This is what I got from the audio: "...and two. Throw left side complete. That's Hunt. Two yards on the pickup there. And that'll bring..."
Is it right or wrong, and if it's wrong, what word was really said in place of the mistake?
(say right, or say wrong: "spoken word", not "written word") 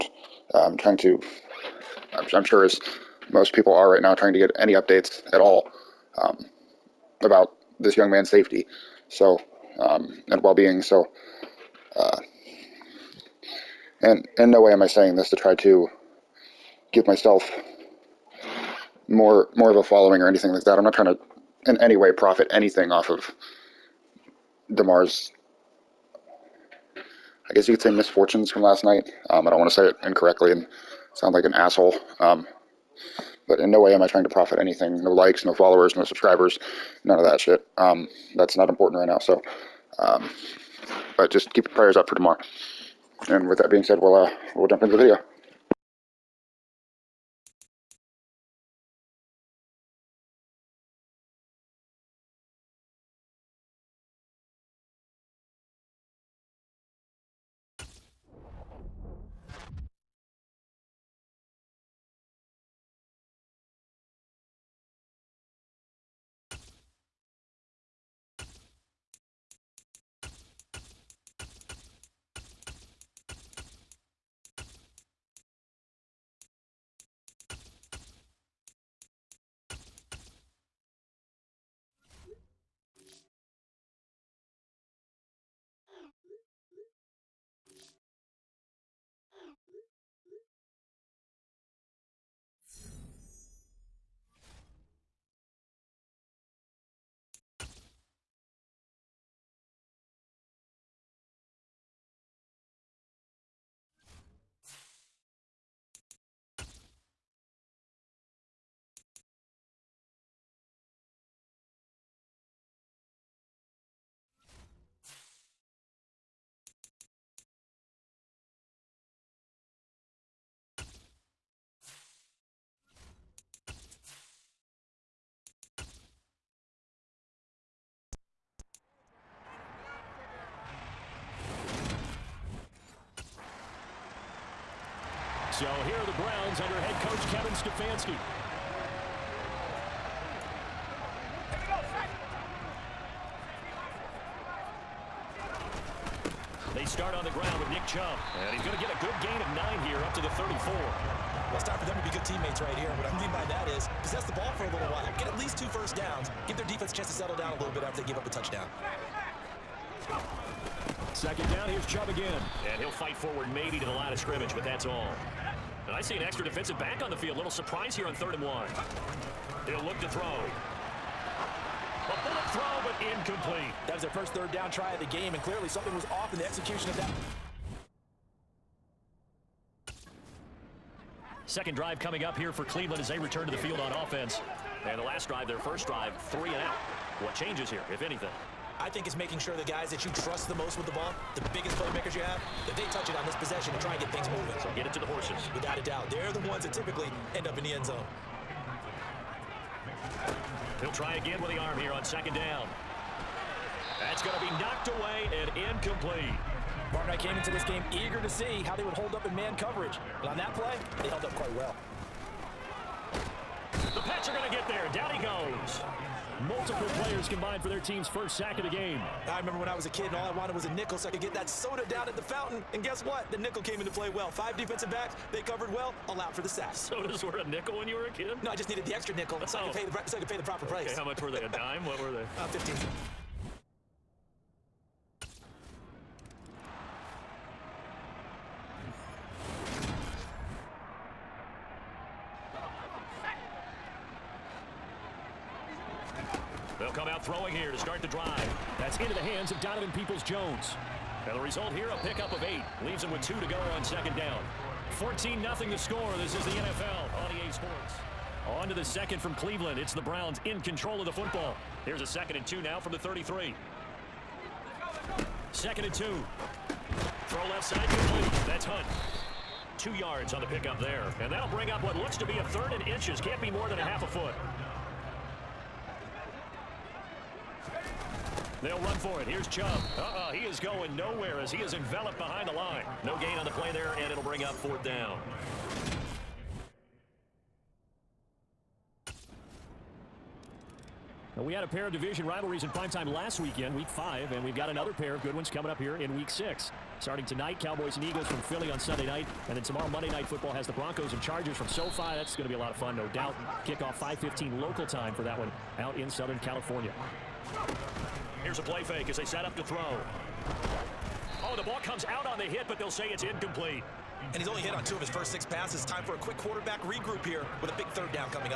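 right.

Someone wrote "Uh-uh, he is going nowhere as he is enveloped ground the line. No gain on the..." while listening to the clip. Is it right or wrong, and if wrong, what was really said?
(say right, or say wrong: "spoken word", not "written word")
wrong: "behind", not "ground".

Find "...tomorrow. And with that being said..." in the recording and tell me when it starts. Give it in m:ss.
0:42.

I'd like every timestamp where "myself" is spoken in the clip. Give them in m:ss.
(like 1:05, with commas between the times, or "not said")
0:17.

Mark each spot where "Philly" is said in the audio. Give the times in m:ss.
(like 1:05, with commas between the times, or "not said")
4:58.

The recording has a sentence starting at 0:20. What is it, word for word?
I'm not trying to in any way profit anything off of Damar's.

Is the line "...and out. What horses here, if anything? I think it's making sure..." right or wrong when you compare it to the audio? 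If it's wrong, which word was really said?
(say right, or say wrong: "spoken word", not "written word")
wrong: "changes", not "horses".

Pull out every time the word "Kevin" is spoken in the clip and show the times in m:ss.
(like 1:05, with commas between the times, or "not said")
2:17.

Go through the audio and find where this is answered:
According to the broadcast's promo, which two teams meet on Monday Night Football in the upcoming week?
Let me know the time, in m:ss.
5:00.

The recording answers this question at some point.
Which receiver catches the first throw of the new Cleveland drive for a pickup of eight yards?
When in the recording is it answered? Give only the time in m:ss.
4:09.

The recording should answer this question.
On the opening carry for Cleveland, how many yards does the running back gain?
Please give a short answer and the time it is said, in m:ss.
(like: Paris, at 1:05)
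9, at 2:29.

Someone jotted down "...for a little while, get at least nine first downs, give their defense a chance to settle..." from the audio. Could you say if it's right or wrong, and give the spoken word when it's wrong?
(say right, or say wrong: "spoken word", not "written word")
wrong: "two", not "nine".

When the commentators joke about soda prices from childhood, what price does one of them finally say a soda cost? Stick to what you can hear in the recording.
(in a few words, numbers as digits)
15 cents.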